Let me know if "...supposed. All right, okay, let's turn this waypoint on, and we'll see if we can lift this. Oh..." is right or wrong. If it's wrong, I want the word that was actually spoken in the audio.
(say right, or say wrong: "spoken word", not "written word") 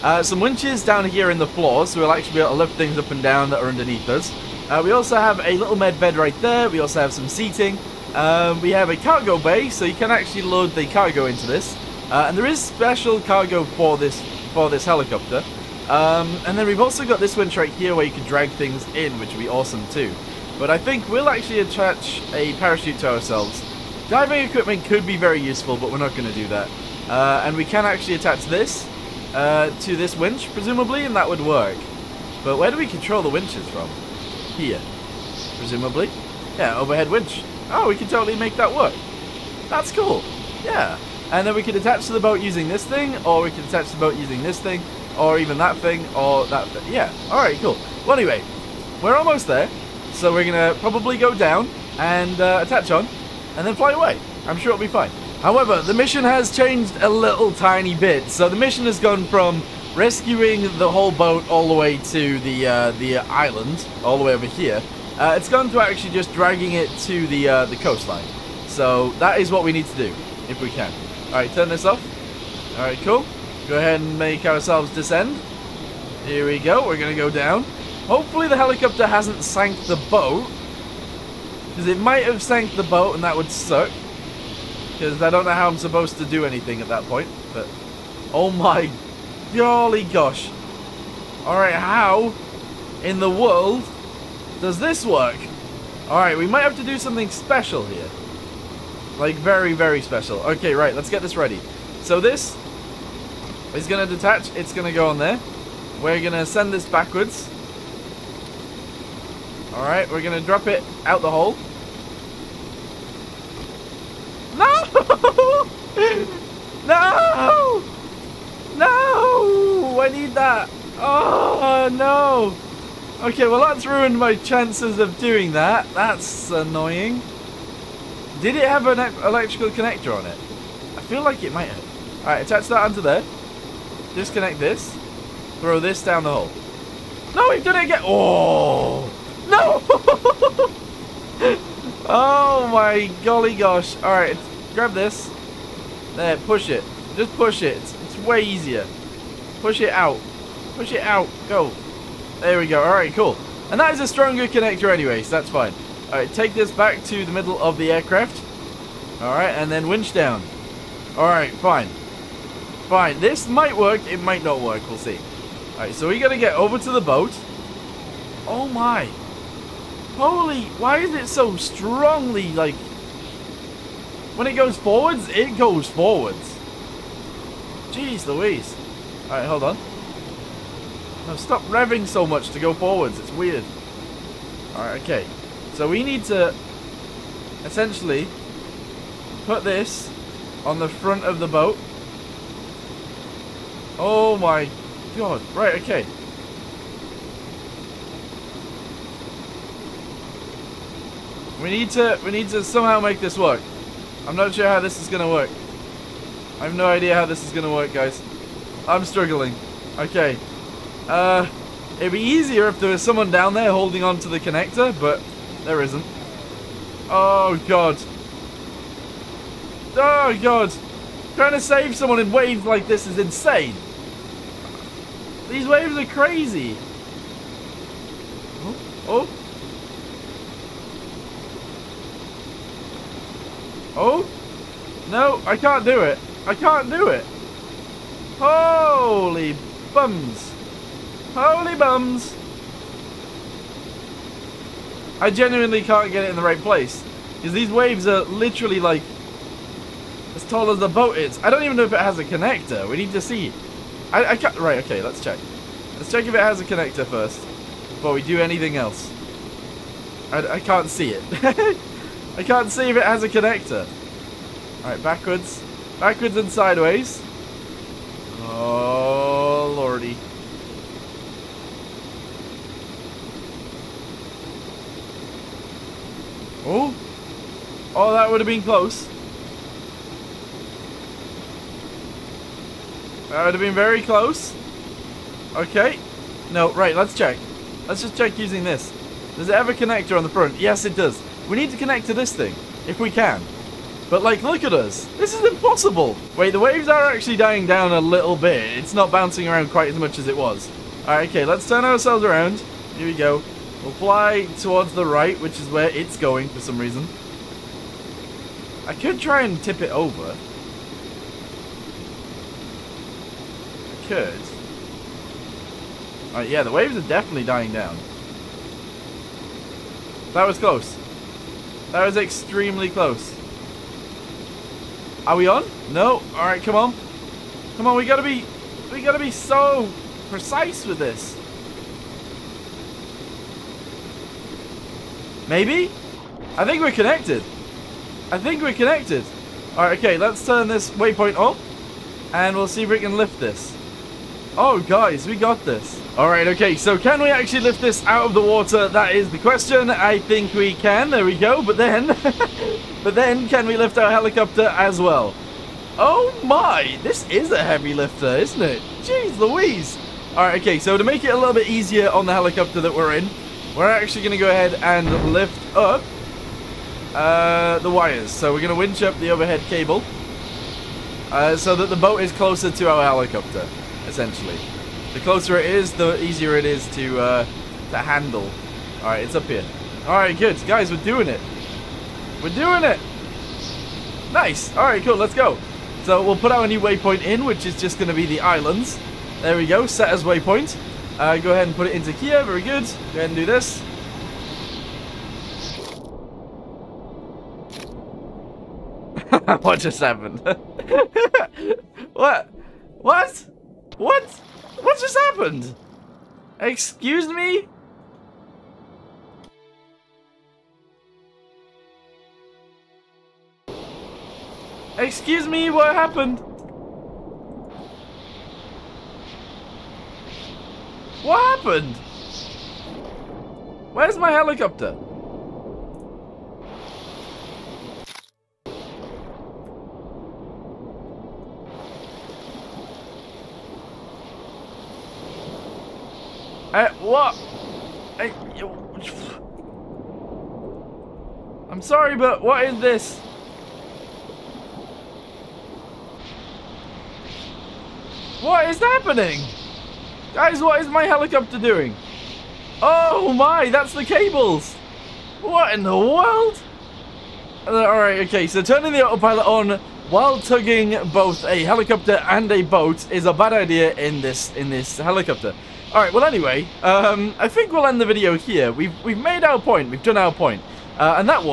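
wrong: "connected", not "supposed".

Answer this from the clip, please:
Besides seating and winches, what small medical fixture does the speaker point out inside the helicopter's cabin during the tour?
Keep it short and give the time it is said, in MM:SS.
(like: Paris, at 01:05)
med bed, at 00:05.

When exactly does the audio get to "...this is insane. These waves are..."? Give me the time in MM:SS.
03:42.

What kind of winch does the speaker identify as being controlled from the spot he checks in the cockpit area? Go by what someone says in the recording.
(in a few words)
overhead winch.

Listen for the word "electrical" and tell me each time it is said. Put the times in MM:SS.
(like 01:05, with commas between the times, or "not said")
02:09.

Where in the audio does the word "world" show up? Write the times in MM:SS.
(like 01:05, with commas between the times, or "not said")
01:33, 07:35.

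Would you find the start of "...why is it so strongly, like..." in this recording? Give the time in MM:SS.
02:50.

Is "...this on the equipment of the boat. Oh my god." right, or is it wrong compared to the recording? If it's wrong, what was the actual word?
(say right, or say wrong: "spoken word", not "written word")
wrong: "front", not "equipment".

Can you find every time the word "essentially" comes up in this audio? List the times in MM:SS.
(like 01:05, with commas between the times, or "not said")
03:07, 06:14.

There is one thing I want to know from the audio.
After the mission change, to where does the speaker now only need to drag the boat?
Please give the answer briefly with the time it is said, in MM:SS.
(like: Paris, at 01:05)
the coastline, at 01:07.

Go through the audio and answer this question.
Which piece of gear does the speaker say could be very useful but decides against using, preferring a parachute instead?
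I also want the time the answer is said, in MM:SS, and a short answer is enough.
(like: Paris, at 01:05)
Diving equipment, at 00:24.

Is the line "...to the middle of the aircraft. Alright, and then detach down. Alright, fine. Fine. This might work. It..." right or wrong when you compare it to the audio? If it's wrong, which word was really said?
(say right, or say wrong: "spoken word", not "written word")
wrong: "winch", not "detach".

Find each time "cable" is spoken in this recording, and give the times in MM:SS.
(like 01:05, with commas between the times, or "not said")
06:09, 07:34.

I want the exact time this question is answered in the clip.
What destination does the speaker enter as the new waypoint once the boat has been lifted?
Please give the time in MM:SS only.
06:28.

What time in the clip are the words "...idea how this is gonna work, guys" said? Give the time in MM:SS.
03:26.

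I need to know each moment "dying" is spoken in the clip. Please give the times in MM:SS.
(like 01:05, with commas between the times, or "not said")
04:57, 05:17.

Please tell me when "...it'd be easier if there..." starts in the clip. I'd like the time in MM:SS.
03:31.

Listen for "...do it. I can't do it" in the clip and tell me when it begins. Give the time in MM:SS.
03:55.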